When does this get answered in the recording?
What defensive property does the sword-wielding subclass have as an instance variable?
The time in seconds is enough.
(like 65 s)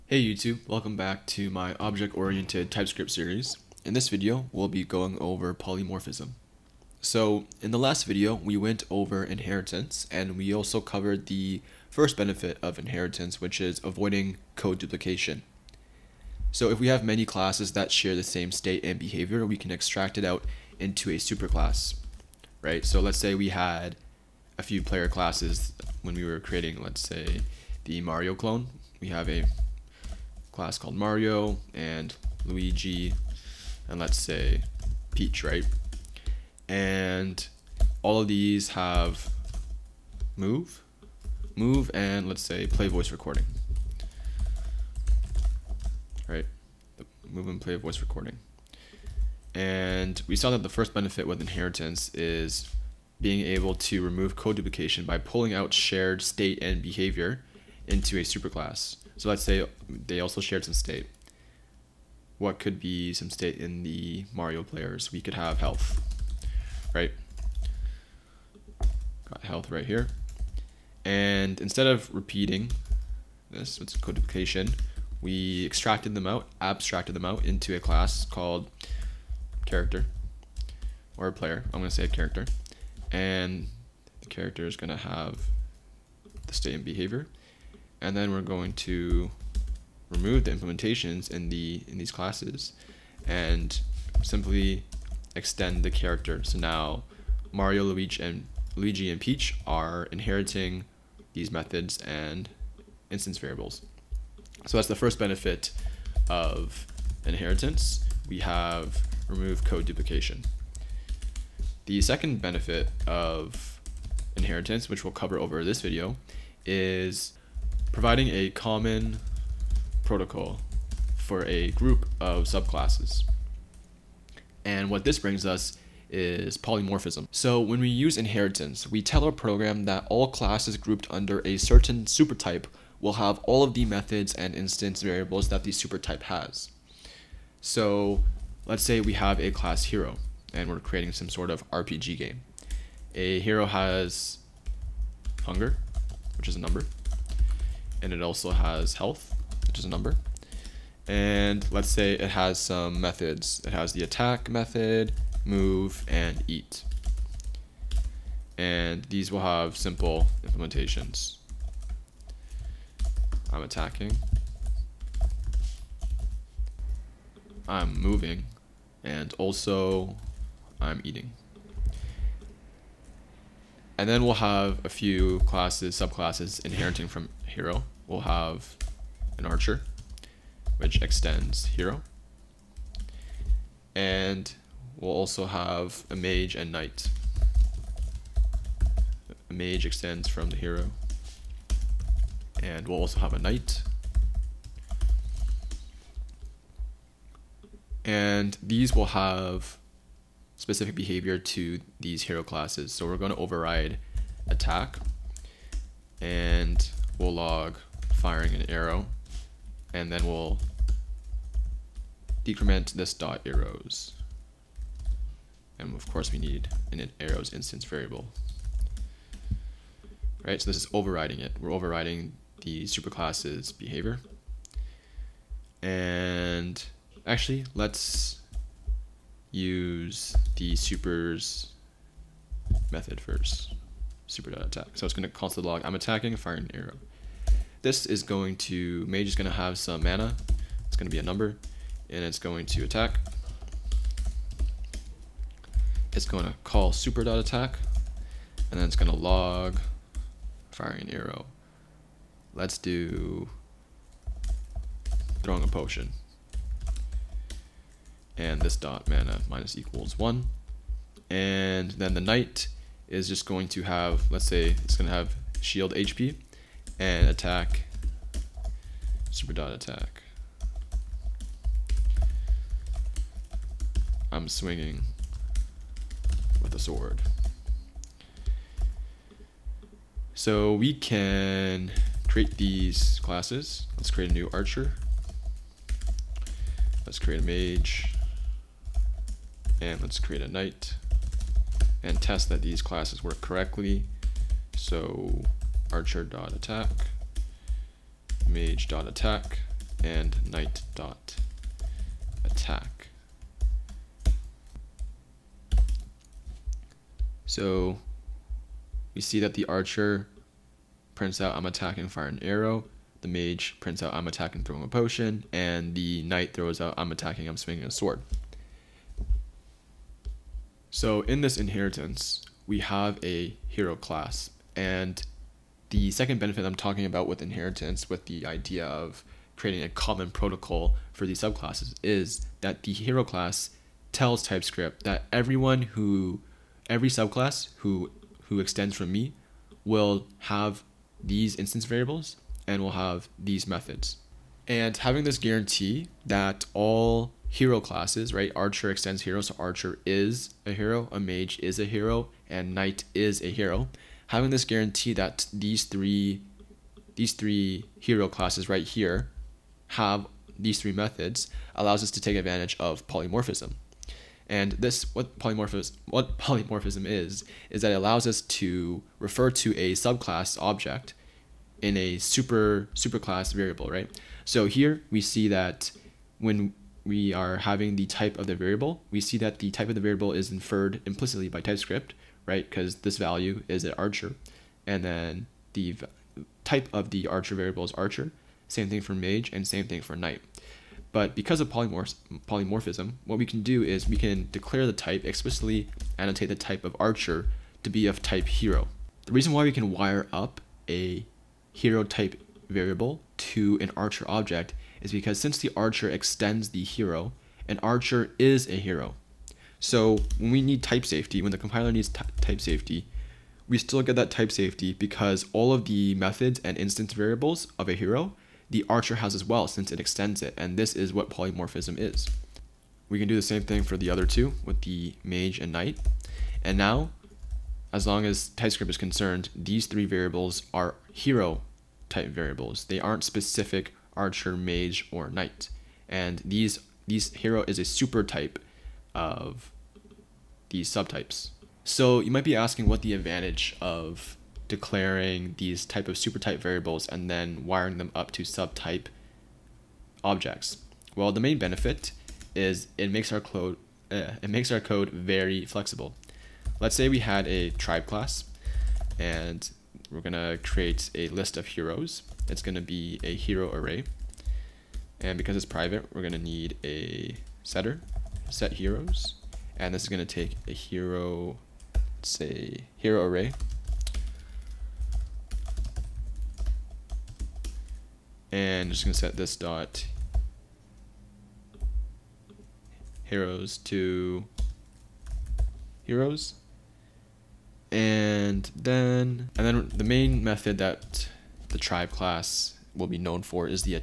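265 s.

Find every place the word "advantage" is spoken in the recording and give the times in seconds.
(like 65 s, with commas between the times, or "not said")
362 s, 443 s.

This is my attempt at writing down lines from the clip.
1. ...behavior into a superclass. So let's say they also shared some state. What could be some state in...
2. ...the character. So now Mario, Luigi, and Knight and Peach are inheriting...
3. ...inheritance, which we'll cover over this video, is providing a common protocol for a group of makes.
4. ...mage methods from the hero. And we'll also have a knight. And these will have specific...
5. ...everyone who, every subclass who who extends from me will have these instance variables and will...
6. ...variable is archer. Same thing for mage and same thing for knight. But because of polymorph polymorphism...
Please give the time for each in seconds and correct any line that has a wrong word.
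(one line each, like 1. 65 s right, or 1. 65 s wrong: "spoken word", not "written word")
1. 56 s right
2. 95 s wrong: "Luigi", not "Knight"
3. 114 s wrong: "subclasses", not "makes"
4. 189 s wrong: "extends", not "methods"
5. 335 s right
6. 387 s right.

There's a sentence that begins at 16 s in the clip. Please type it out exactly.
So if we have many classes that share the same state and behavior, we can extract it out into a superclass, right?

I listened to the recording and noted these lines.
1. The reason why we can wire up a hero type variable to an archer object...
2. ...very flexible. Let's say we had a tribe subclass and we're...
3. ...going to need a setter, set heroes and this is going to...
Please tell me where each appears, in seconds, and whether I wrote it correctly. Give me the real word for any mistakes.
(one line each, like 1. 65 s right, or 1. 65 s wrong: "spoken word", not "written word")
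1. 399 s right
2. 455 s wrong: "class", not "subclass"
3. 466 s right.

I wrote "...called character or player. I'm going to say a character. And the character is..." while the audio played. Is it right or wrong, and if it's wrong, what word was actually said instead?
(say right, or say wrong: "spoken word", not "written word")
right.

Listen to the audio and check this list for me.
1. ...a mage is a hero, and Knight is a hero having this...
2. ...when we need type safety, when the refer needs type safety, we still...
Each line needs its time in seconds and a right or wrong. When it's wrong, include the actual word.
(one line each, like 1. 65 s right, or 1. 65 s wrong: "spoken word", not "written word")
1. 351 s right
2. 410 s wrong: "compiler", not "refer".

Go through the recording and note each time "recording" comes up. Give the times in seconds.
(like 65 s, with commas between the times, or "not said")
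43 s, 47 s.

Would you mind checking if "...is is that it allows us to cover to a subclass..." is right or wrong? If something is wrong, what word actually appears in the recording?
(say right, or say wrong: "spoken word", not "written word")
wrong: "refer", not "cover".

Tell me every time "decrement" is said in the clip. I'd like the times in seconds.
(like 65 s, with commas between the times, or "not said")
212 s.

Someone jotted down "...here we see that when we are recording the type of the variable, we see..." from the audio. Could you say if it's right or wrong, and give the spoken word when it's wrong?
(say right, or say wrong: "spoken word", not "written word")
wrong: "having", not "recording".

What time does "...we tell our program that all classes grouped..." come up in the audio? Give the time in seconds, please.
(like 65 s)
128 s.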